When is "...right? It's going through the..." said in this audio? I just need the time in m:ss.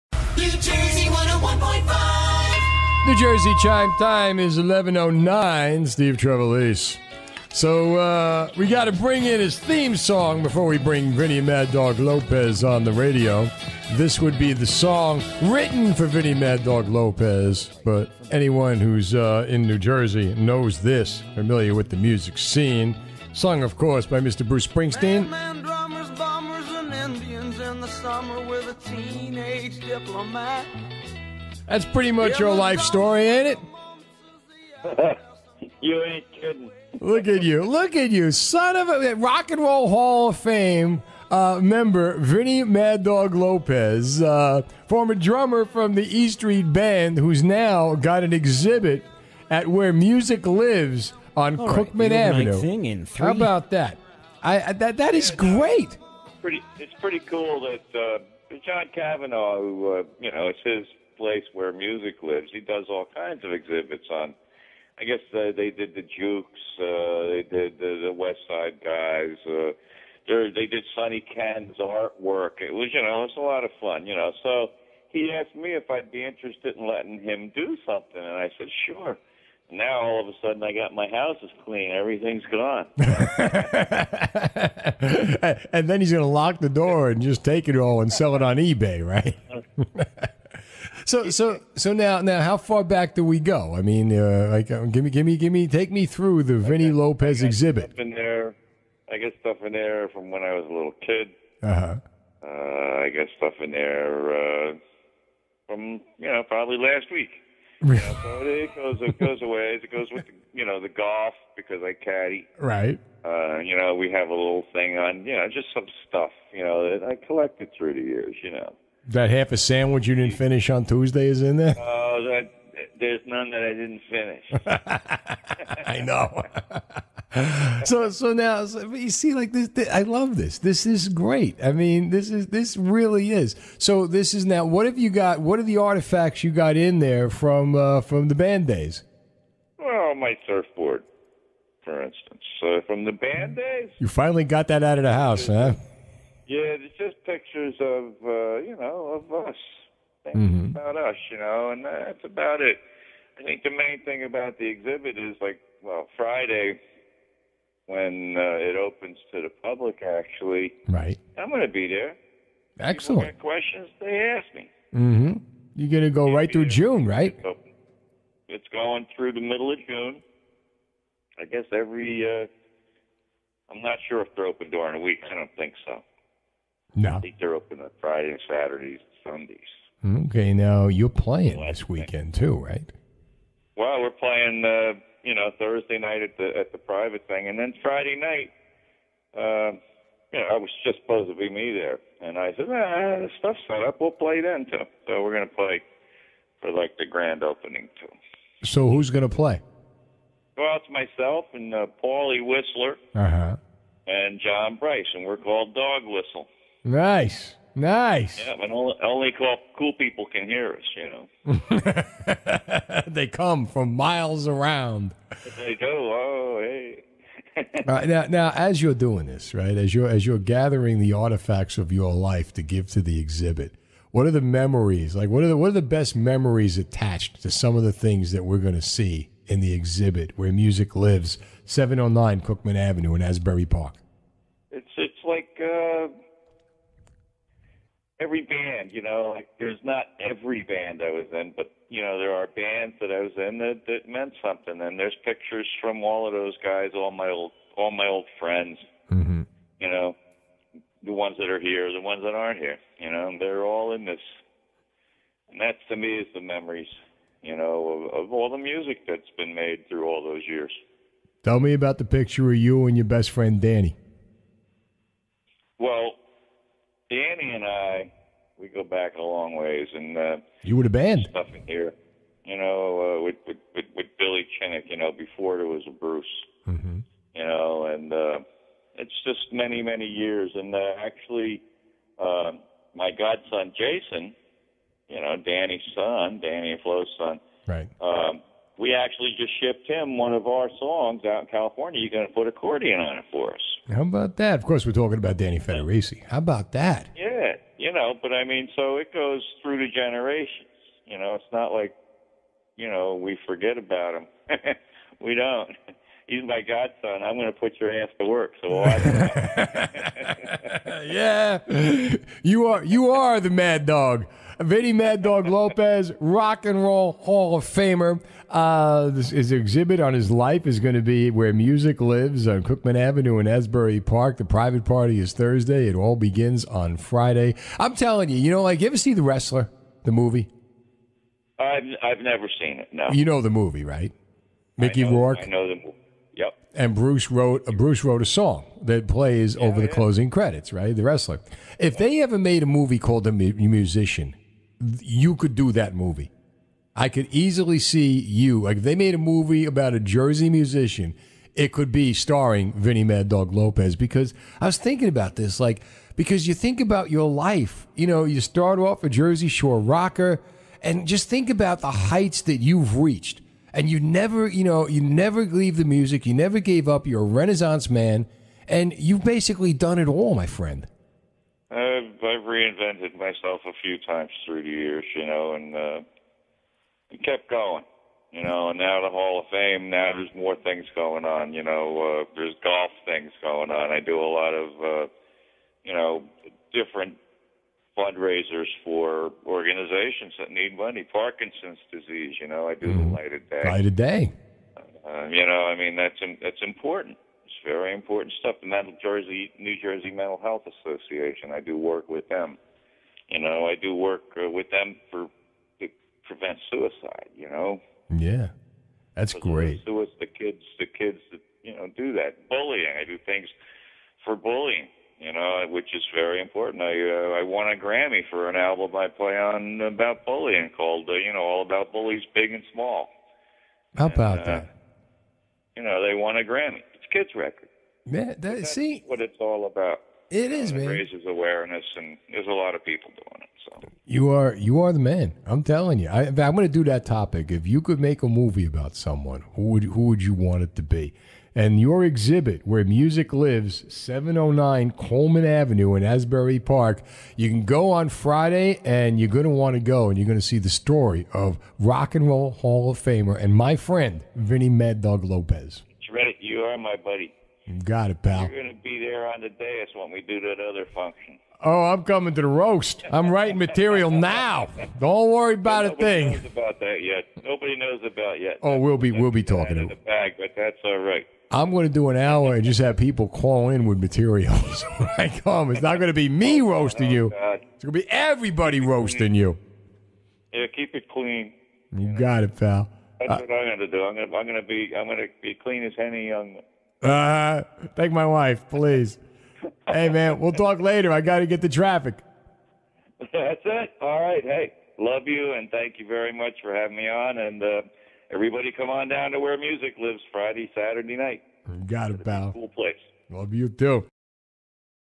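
2:47.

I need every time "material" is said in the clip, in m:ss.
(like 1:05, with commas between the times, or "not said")
7:43, 7:53.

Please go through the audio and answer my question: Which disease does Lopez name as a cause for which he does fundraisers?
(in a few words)
Parkinson's disease.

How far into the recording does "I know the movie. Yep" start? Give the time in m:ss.
5:35.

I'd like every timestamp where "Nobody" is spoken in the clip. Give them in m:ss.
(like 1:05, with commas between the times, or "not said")
7:47.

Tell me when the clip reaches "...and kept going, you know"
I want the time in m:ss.
6:17.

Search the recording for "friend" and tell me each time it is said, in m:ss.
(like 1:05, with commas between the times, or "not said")
4:08, 4:23, 6:10, 7:33.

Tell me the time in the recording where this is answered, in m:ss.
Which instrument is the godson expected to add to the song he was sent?
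4:52.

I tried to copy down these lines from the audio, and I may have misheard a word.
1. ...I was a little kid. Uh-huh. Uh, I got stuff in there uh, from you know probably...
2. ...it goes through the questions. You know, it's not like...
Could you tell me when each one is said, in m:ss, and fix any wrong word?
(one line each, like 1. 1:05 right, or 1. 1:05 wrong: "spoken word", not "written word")
1. 1:40 right
2. 4:58 wrong: "generations", not "questions".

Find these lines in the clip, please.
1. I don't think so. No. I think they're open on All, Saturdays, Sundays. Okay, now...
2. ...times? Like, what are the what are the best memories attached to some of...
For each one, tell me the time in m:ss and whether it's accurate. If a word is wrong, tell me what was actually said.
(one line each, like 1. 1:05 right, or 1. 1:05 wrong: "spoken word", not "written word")
1. 2:55 wrong: "Fridays", not "All"
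2. 3:44 wrong: "memories", not "times".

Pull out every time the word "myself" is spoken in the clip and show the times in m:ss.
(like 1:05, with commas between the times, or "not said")
3:20, 6:13.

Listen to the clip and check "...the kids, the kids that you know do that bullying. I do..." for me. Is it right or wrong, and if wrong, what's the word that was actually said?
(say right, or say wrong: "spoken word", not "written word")
right.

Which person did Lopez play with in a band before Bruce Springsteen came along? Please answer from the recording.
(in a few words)
Billy Chinnock.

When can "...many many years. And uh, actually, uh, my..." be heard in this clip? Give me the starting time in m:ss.
4:39.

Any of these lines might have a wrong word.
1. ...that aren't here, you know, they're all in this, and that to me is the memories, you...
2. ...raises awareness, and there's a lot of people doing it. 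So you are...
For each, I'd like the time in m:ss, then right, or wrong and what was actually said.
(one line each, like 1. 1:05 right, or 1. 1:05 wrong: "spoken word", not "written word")
1. 4:12 right
2. 7:10 right.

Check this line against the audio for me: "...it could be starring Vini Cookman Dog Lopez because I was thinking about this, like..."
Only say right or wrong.
wrong.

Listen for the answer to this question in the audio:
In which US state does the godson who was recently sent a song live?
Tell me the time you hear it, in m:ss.
4:51.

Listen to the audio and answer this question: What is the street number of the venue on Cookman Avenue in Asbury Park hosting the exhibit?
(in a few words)
709.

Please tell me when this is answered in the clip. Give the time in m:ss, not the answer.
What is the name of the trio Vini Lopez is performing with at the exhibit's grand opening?
3:25.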